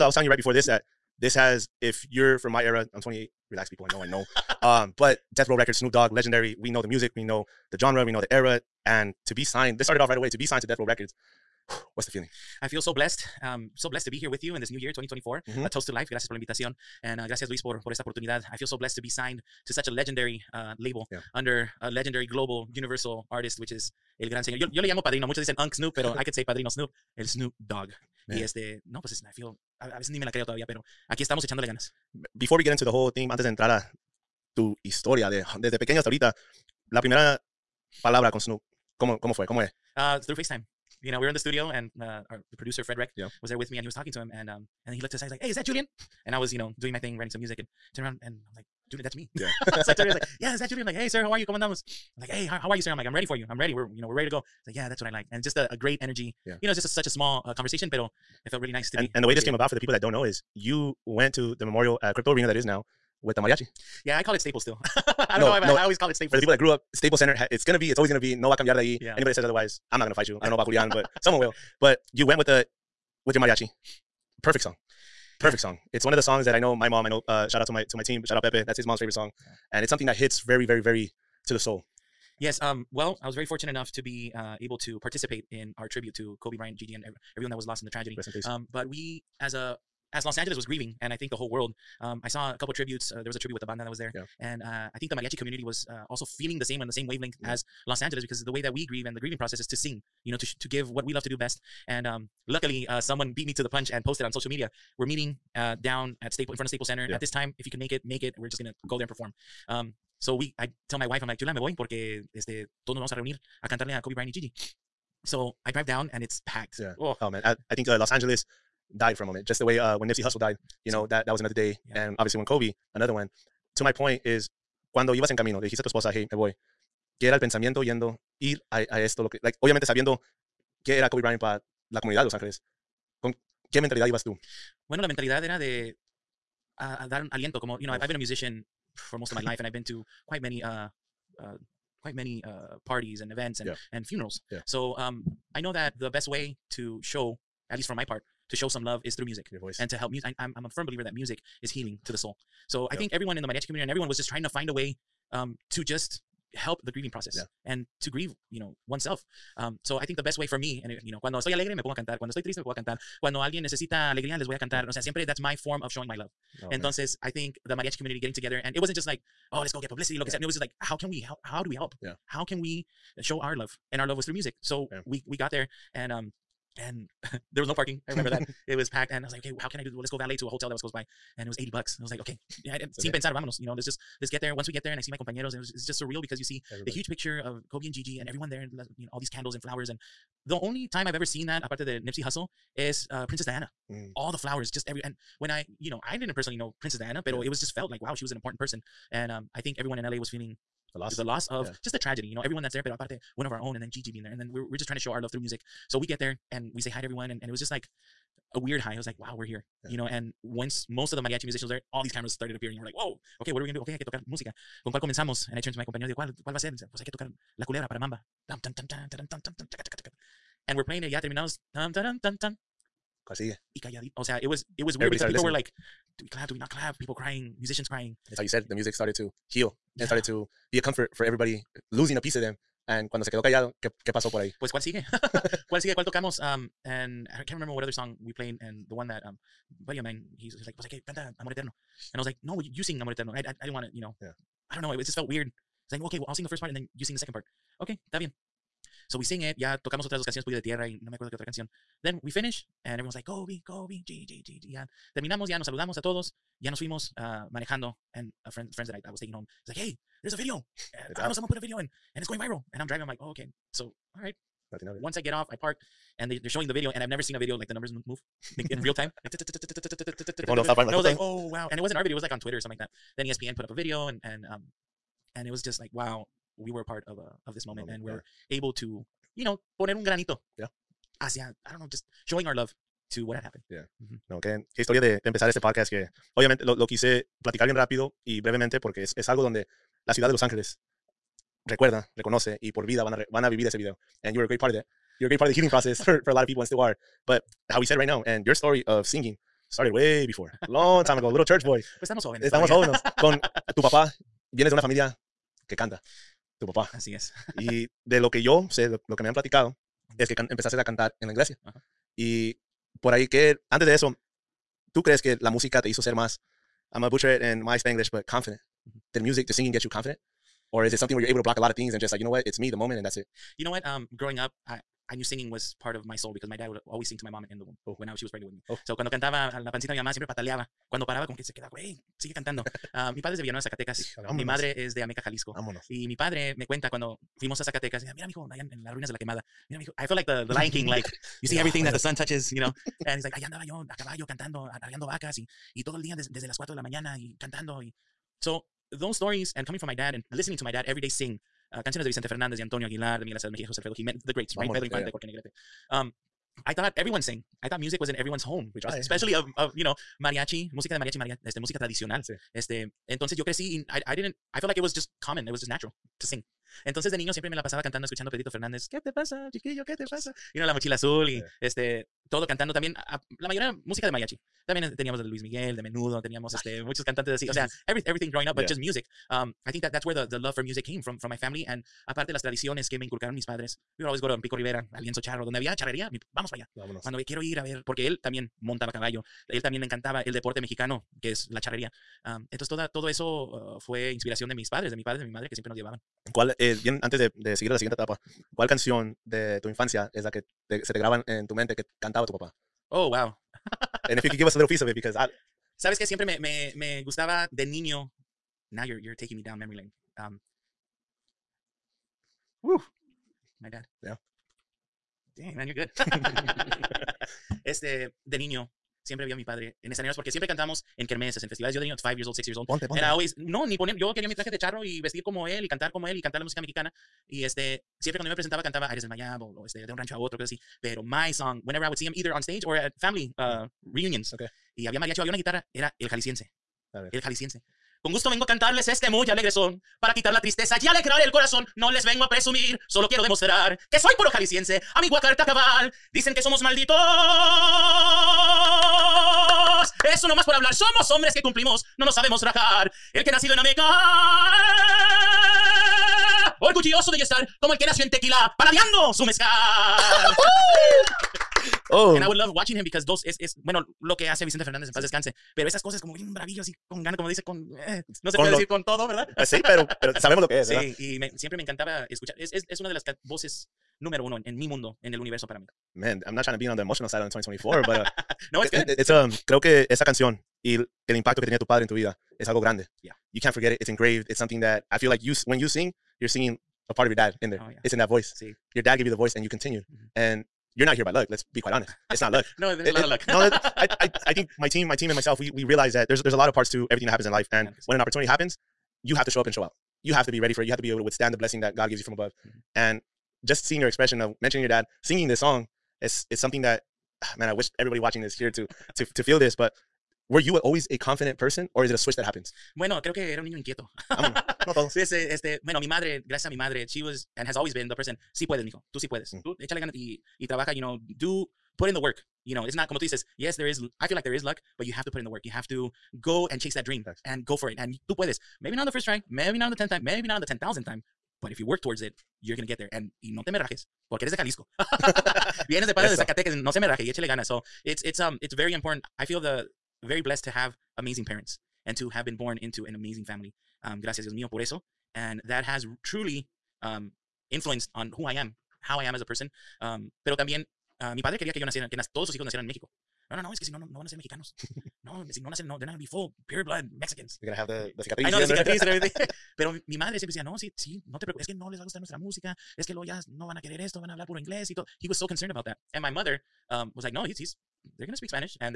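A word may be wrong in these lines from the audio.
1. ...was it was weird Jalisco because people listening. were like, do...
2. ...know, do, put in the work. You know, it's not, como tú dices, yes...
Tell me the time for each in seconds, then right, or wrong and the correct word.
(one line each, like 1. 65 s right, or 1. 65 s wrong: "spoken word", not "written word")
1. 224 s wrong: "Everybody", not "Jalisco"
2. 520 s right.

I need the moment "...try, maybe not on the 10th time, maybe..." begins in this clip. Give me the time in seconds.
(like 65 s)
529 s.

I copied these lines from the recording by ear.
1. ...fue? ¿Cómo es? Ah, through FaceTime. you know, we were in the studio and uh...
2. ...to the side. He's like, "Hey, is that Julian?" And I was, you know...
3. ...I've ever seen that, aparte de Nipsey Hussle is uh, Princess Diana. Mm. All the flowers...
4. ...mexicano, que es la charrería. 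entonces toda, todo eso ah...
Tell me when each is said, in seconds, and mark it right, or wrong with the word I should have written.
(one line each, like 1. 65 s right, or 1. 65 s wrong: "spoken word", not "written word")
1. 39 s right
2. 45 s right
3. 191 s right
4. 390 s right.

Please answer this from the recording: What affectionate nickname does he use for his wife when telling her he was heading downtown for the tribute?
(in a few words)
Chula.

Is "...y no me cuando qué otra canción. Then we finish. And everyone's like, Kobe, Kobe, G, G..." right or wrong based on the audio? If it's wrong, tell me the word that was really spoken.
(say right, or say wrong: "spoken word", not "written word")
wrong: "acuerdo", not "cuando".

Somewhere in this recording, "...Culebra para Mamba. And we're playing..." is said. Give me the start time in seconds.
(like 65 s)
217 s.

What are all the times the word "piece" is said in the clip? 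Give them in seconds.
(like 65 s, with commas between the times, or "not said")
232 s, 404 s.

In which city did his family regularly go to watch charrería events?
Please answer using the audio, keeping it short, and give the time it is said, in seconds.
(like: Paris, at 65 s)
Pico Rivera, at 384 s.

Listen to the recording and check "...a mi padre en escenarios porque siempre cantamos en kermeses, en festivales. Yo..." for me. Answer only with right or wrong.
right.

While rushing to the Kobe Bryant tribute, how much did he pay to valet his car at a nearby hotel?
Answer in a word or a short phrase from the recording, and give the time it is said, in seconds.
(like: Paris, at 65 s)
$80, at 181 s.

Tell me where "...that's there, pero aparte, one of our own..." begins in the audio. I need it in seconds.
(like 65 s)
202 s.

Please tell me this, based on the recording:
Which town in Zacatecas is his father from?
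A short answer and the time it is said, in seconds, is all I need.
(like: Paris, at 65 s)
Villanueva, at 333 s.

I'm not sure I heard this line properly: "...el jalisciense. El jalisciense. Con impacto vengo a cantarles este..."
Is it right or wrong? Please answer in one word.
wrong.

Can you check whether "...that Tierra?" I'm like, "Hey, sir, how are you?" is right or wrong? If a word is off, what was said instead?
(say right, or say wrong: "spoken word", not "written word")
wrong: "Julian", not "Tierra".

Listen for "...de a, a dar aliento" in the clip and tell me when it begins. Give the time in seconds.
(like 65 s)
135 s.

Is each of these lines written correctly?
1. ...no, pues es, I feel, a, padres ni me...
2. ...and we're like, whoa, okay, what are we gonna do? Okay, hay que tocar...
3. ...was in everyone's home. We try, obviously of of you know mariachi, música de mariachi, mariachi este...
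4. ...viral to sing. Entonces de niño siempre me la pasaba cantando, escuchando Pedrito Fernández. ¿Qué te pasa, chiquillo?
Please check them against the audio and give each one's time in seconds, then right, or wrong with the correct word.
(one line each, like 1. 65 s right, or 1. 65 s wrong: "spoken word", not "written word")
1. 28 s wrong: "veces", not "padres"
2. 212 s right
3. 357 s wrong: "especially", not "obviously"
4. 365 s wrong: "natural", not "viral".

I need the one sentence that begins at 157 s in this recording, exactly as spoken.
and to grieve, you know, oneself.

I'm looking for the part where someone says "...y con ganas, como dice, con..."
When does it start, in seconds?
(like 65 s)
466 s.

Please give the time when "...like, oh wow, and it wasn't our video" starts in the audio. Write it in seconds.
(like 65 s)
271 s.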